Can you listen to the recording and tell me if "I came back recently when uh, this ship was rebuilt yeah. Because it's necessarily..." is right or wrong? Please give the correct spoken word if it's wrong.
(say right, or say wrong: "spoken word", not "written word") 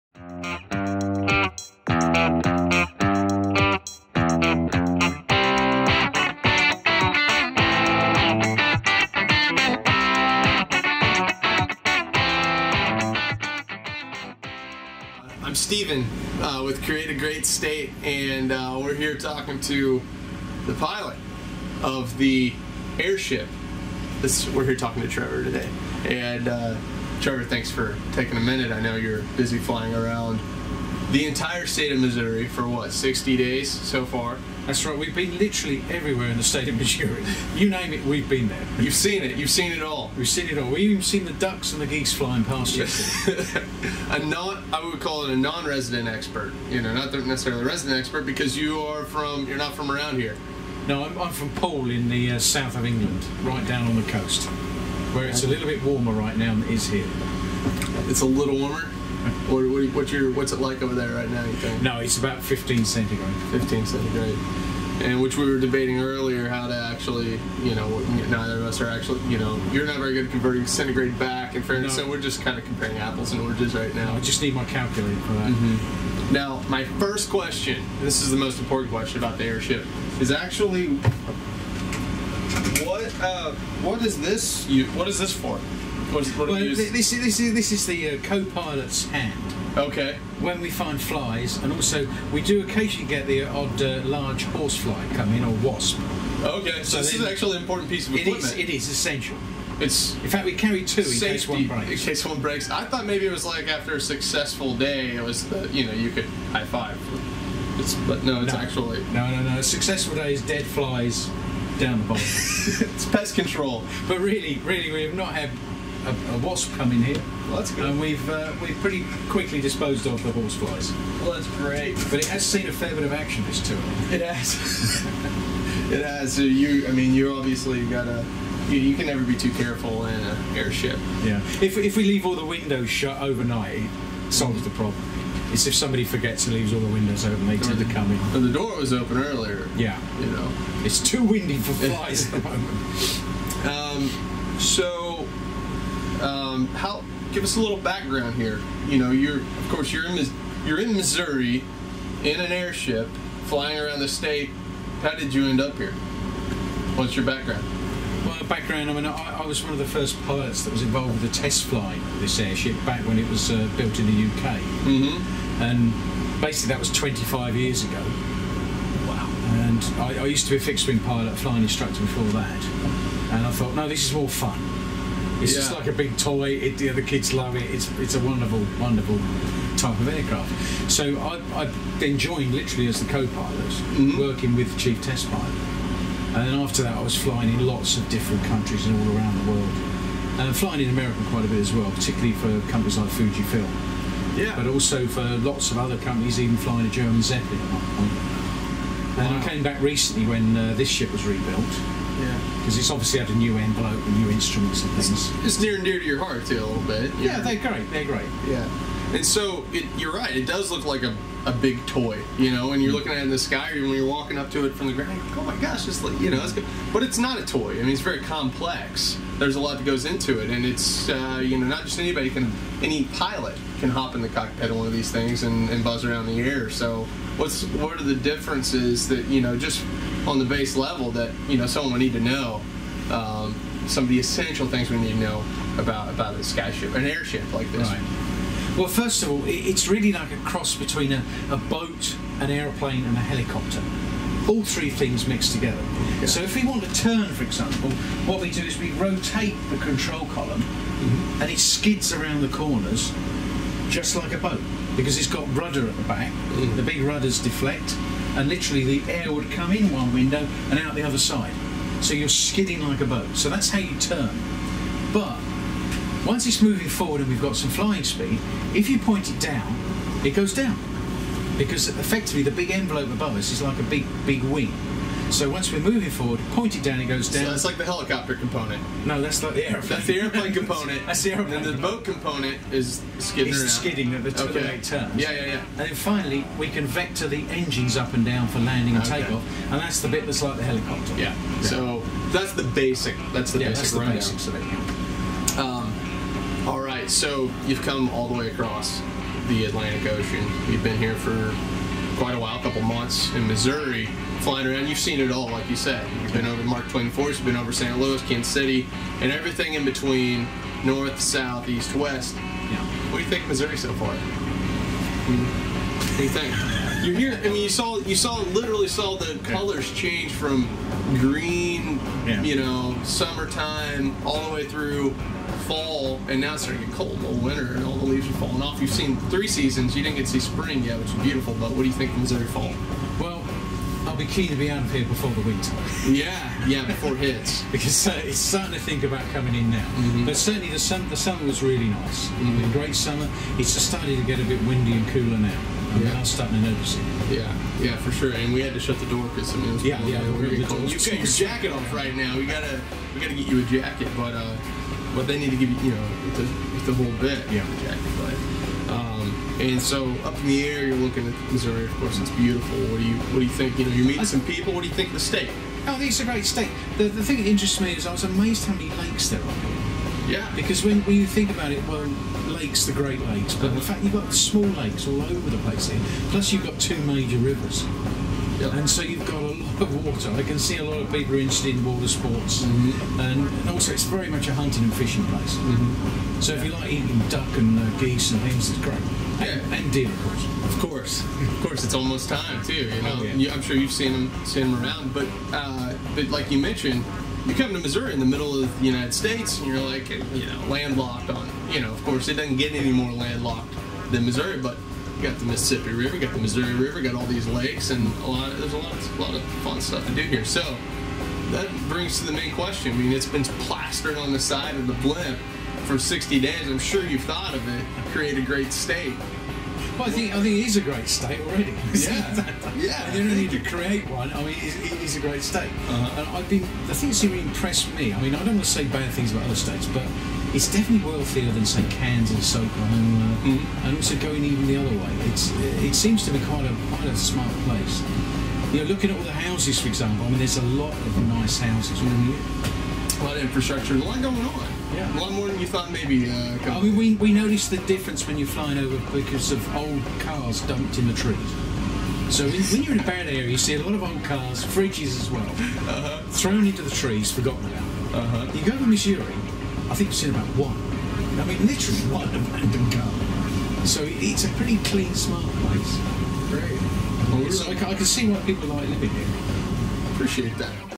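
wrong: "obviously", not "necessarily".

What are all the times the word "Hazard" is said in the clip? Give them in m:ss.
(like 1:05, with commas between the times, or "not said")
not said.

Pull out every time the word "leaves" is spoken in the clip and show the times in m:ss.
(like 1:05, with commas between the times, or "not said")
2:12, 2:16, 5:28.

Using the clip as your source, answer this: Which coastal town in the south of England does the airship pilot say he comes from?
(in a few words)
Poole.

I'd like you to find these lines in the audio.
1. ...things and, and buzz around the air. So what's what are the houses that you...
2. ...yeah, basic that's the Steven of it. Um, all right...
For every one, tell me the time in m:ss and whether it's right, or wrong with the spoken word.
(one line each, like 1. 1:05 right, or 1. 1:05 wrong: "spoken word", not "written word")
1. 3:45 wrong: "differences", not "houses"
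2. 4:53 wrong: "Basics", not "Steven".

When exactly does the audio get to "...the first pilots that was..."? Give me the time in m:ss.
2:39.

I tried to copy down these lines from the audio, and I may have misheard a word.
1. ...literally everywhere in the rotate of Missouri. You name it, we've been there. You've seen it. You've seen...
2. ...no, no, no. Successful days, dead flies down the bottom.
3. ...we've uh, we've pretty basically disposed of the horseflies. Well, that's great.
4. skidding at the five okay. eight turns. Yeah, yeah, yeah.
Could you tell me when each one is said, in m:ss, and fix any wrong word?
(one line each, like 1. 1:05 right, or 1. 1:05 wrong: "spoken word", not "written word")
1. 0:35 wrong: "state", not "rotate"
2. 1:49 right
3. 1:57 wrong: "quickly", not "basically"
4. 4:43 wrong: "two", not "five".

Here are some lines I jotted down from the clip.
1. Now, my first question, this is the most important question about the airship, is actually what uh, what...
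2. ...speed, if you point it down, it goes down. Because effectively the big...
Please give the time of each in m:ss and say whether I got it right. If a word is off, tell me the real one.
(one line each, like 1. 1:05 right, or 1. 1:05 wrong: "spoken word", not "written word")
1. 1:16 right
2. 4:28 right.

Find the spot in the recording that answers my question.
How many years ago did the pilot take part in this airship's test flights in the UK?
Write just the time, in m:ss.
2:46.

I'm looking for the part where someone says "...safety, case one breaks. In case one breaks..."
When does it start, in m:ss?
1:41.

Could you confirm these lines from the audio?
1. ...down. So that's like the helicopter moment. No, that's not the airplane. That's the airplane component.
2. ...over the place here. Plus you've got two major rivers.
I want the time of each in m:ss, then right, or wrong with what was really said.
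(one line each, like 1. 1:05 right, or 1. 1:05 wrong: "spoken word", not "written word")
1. 4:37 wrong: "component", not "moment"
2. 6:15 right.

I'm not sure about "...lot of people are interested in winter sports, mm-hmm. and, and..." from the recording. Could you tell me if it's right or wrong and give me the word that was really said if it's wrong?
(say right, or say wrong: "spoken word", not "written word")
wrong: "water", not "winter".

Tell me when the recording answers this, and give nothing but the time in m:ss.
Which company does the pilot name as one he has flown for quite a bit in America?
3:13.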